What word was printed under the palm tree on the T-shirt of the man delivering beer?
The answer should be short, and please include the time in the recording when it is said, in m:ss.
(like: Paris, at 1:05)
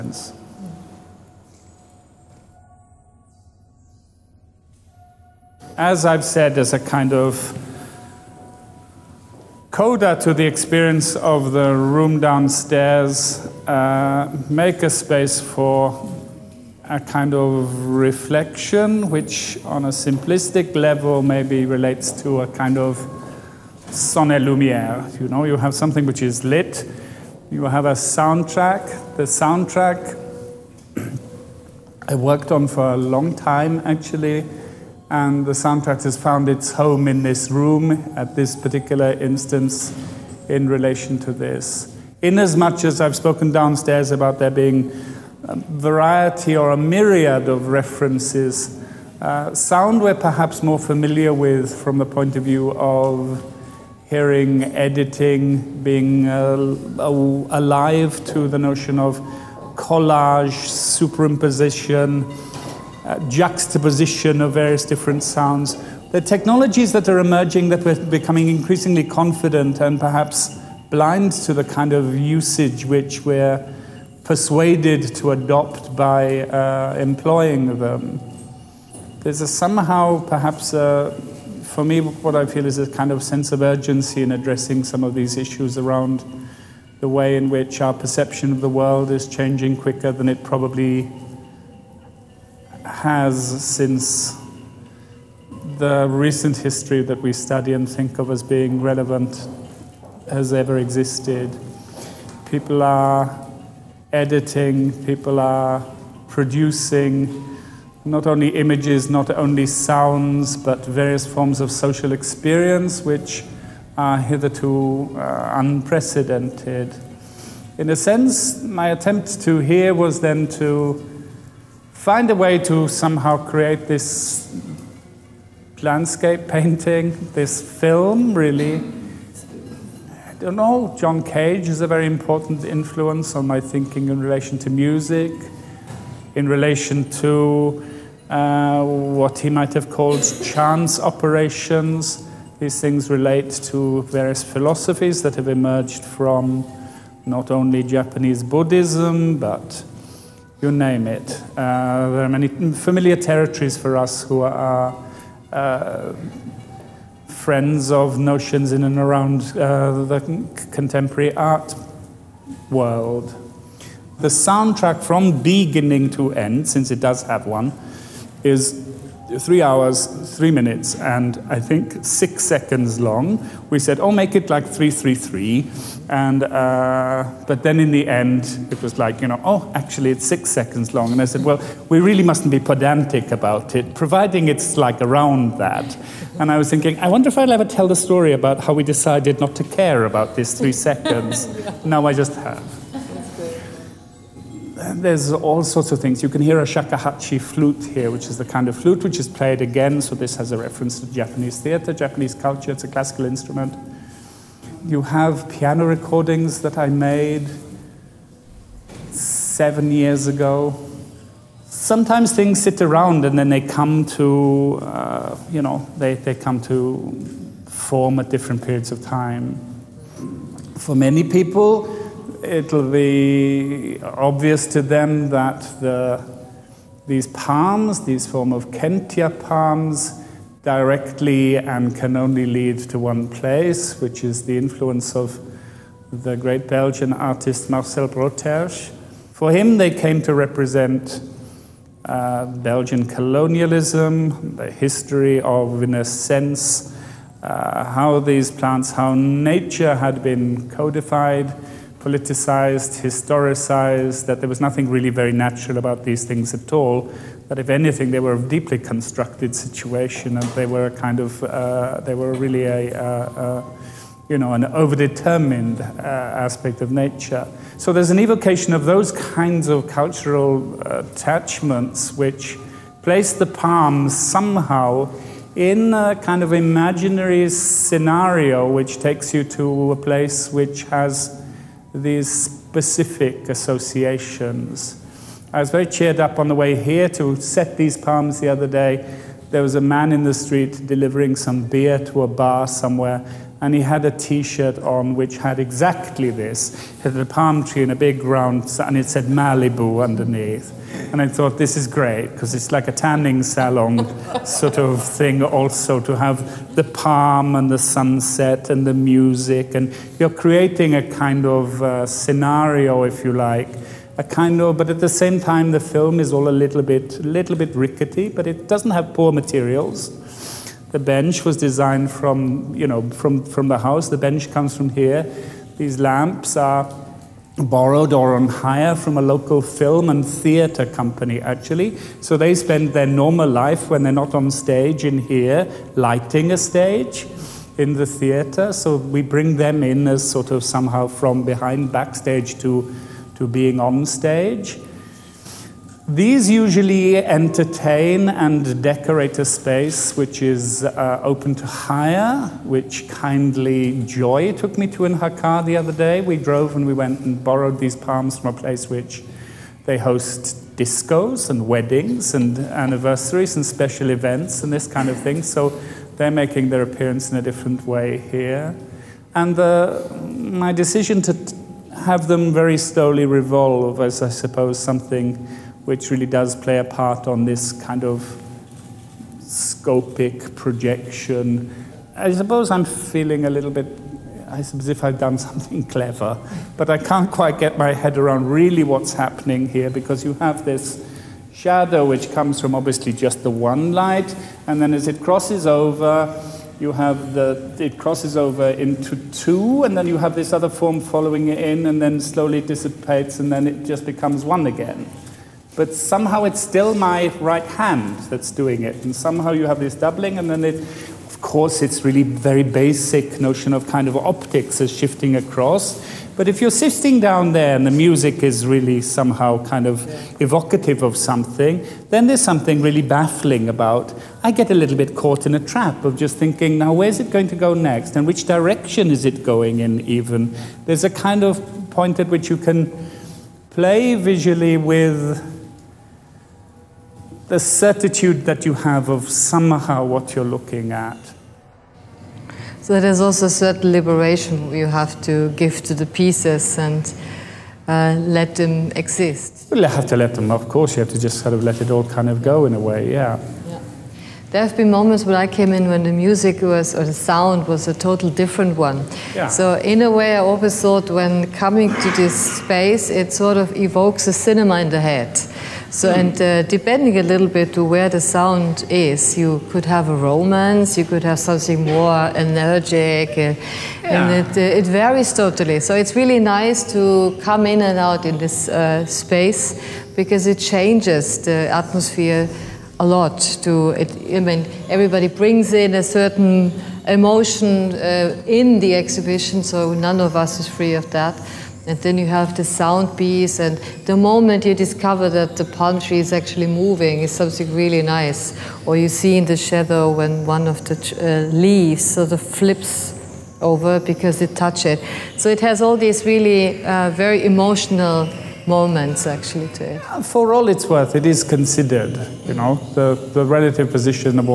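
Malibu, at 4:59.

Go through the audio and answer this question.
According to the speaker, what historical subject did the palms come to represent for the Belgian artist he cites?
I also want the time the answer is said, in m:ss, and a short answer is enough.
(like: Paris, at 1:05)
Belgian colonialism, at 4:02.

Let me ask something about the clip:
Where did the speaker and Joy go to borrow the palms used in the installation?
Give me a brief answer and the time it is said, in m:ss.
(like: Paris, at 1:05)
Hakka, at 5:55.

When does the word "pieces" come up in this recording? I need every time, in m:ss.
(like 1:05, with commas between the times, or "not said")
7:26, 8:13.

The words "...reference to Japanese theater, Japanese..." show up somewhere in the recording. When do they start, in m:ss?
3:20.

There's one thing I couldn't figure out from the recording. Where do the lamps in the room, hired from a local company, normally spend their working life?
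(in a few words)
the theatre.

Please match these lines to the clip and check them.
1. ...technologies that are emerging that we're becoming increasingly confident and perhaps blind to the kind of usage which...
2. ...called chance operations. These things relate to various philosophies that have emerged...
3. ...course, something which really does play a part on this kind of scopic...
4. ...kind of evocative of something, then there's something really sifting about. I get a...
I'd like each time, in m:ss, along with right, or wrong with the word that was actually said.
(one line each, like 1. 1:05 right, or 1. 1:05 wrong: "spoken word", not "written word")
1. 1:06 right
2. 2:19 right
3. 6:14 wrong: "suppose", not "course"
4. 6:59 wrong: "baffling", not "sifting".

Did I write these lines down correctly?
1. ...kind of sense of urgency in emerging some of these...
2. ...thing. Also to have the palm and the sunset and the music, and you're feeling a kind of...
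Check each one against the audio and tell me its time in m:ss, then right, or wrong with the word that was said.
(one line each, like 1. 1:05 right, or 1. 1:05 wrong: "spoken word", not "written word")
1. 1:22 wrong: "addressing", not "emerging"
2. 5:05 wrong: "creating", not "feeling".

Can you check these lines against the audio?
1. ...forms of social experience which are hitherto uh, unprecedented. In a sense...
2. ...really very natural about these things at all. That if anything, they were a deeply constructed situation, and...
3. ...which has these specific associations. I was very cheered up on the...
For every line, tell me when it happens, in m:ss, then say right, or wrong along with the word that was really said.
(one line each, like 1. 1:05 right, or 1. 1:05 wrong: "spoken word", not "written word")
1. 1:51 right
2. 4:14 right
3. 4:40 right.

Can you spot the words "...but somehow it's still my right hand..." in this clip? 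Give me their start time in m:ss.
6:45.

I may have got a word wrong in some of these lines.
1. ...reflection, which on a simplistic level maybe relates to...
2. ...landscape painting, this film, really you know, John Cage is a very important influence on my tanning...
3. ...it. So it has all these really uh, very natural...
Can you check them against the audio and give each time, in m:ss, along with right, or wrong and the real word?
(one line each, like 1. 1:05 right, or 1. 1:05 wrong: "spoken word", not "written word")
1. 0:17 right
2. 2:05 wrong: "thinking", not "tanning"
3. 8:24 wrong: "emotional", not "natural".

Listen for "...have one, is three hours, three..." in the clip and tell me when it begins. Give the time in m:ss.
2:47.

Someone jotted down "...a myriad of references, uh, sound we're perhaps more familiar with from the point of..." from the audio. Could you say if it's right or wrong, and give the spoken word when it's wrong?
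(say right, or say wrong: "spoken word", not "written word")
right.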